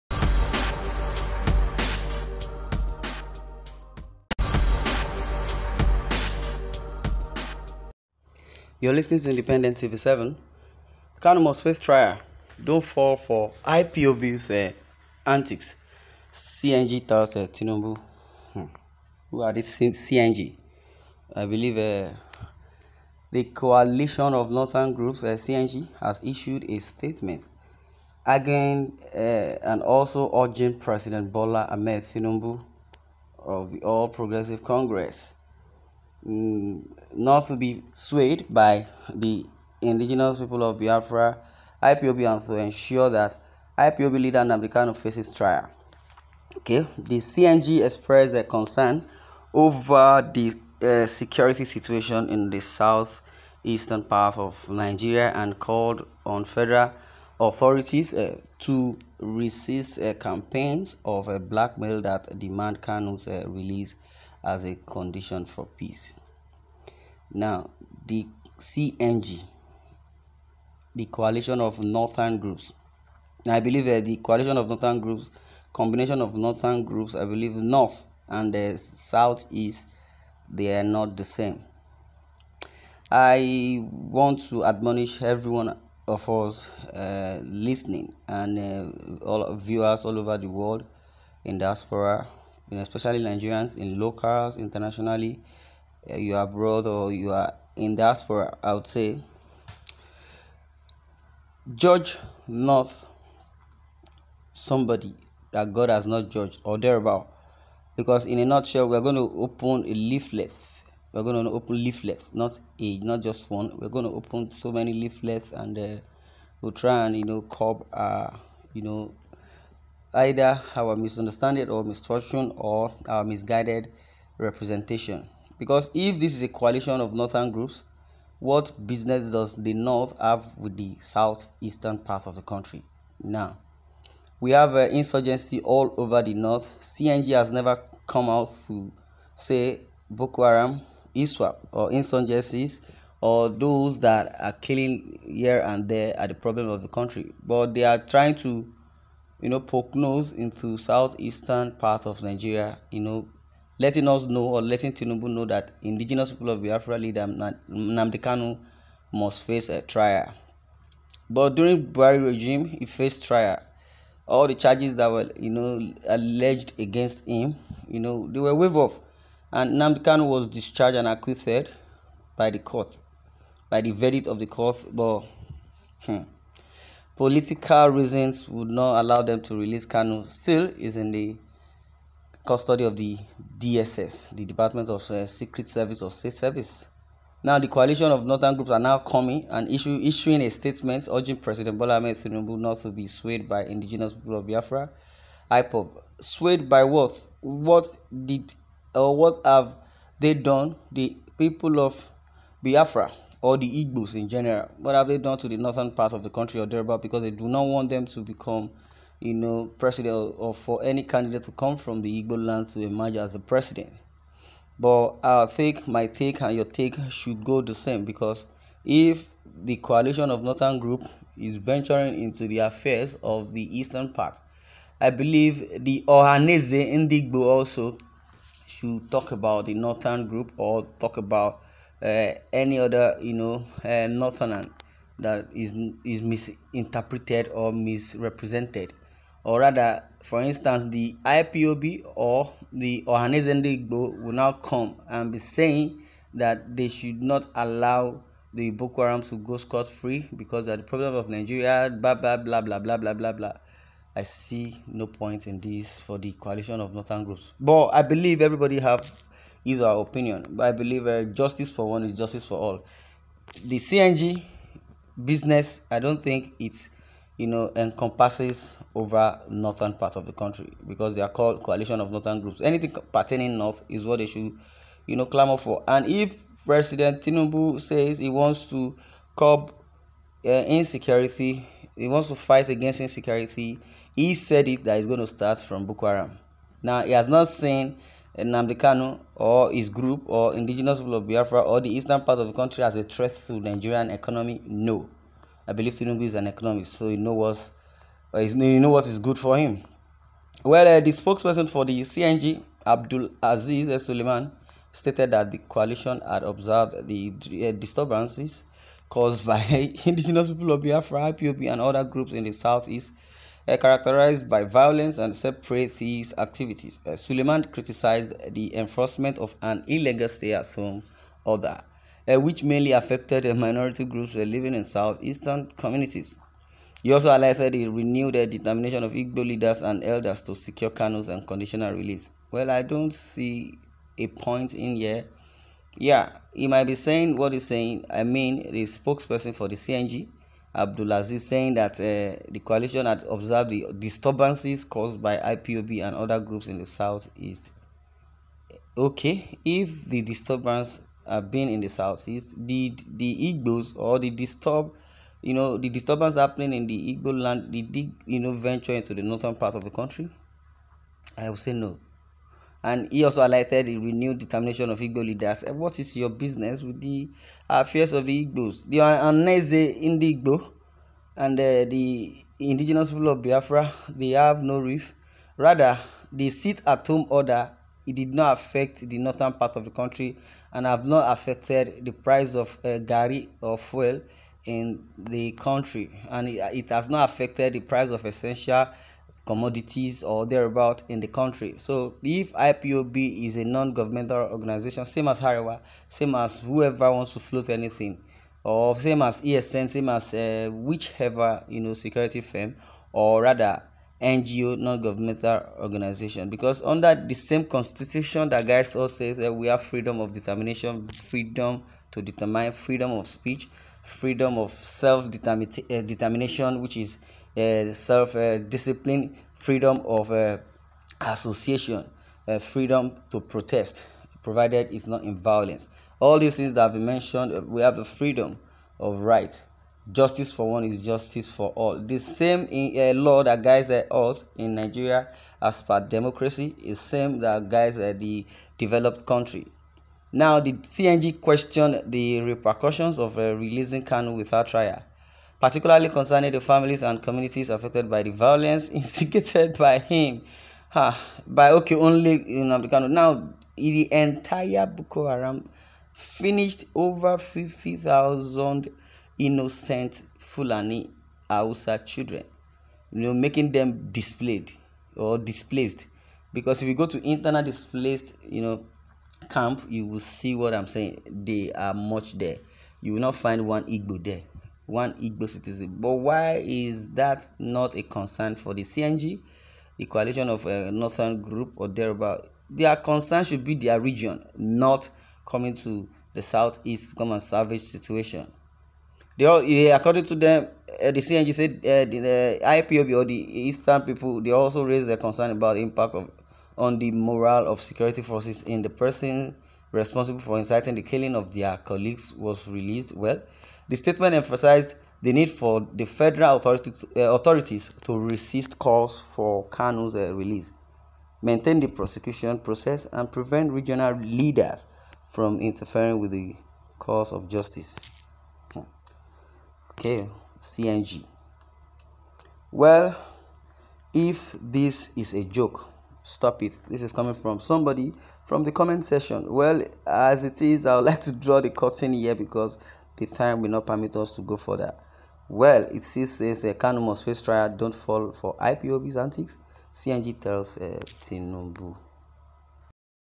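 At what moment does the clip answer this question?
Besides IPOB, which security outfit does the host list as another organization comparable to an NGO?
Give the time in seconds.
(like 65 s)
399 s.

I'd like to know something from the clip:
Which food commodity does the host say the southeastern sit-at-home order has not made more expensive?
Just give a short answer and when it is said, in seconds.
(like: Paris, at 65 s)
gari, at 382 s.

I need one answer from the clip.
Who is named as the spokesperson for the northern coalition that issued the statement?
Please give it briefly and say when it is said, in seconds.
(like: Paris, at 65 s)
Abdul Aziz Suleiman, at 302 s.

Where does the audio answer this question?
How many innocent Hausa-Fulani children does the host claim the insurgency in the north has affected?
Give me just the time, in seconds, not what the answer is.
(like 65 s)
457 s.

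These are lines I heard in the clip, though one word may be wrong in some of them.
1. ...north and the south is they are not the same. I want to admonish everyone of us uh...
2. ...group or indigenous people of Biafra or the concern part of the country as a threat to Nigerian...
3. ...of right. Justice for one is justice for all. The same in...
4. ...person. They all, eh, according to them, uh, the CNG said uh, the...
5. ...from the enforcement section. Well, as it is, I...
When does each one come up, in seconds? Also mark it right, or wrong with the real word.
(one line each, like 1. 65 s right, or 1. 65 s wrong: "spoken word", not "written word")
1. 77 s right
2. 289 s wrong: "eastern", not "concern"
3. 429 s right
4. 487 s wrong: "situation", not "person"
5. 528 s wrong: "comment", not "enforcement".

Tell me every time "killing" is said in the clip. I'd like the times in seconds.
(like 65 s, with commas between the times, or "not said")
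144 s, 501 s.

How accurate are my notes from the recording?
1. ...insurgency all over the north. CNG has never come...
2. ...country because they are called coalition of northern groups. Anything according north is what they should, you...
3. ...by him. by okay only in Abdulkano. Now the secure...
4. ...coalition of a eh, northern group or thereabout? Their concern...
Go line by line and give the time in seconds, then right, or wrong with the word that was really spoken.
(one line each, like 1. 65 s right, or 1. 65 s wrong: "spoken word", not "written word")
1. 134 s right
2. 270 s wrong: "pertaining", not "according"
3. 449 s wrong: "entire", not "secure"
4. 480 s right.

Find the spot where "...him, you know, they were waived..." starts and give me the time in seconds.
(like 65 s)
167 s.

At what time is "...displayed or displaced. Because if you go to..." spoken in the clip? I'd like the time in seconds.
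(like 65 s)
464 s.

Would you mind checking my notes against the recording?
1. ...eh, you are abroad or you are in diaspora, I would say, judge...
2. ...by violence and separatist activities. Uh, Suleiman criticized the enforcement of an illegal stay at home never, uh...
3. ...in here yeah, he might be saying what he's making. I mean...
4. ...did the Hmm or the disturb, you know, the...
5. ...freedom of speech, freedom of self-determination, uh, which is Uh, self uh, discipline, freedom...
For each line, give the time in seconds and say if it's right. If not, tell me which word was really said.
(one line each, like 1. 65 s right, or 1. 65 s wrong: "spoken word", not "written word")
1. 96 s right
2. 314 s wrong: "order", not "never"
3. 334 s wrong: "saying", not "making"
4. 352 s wrong: "Igbos", not "Hmm"
5. 412 s right.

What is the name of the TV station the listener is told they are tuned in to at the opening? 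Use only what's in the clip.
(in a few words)
Independent TV7.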